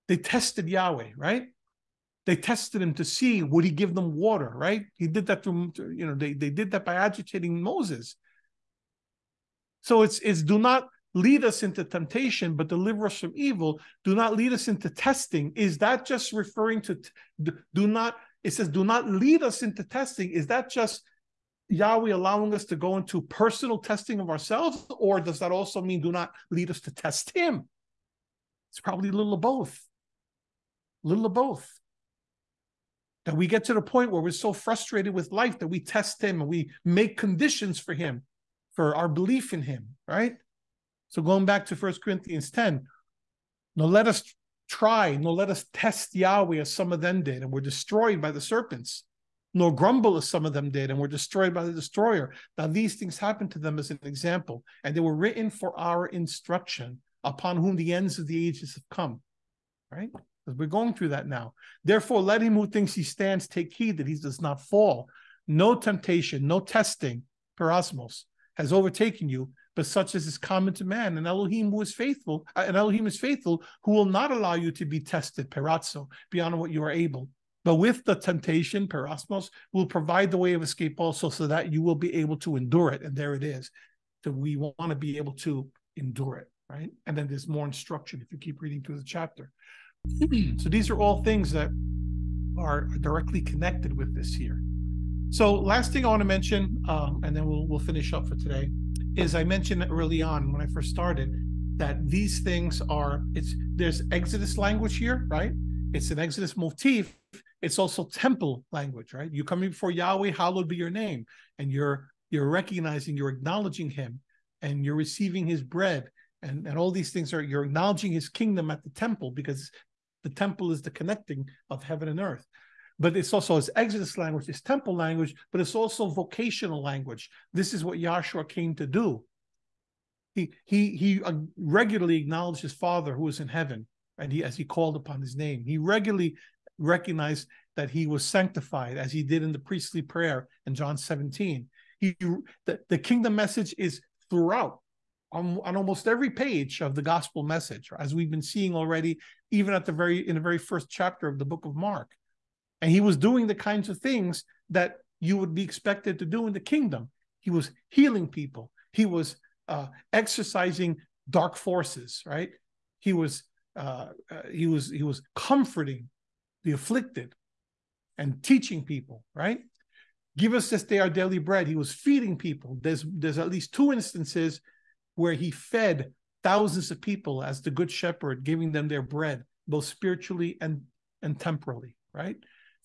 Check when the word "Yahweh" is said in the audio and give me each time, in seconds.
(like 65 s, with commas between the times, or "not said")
0 s, 21 s, 46 s, 109 s.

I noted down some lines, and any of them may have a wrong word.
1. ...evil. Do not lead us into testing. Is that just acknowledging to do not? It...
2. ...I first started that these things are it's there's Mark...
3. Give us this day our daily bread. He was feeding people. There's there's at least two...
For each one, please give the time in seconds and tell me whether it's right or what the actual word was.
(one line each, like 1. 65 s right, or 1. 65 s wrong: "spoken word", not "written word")
1. 13 s wrong: "referring", not "acknowledging"
2. 100 s wrong: "Exodus", not "Mark"
3. 170 s right.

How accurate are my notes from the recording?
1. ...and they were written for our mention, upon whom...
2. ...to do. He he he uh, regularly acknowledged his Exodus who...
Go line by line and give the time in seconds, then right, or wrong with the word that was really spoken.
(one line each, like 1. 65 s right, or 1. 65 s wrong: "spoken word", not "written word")
1. 54 s wrong: "instruction", not "mention"
2. 128 s wrong: "Father", not "Exodus".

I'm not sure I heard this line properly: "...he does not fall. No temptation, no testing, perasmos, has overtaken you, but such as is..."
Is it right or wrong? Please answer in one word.
right.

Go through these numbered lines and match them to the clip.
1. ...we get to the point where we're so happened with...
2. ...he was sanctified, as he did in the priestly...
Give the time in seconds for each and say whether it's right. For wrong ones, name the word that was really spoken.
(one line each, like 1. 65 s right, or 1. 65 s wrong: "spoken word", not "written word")
1. 33 s wrong: "frustrated", not "happened"
2. 137 s right.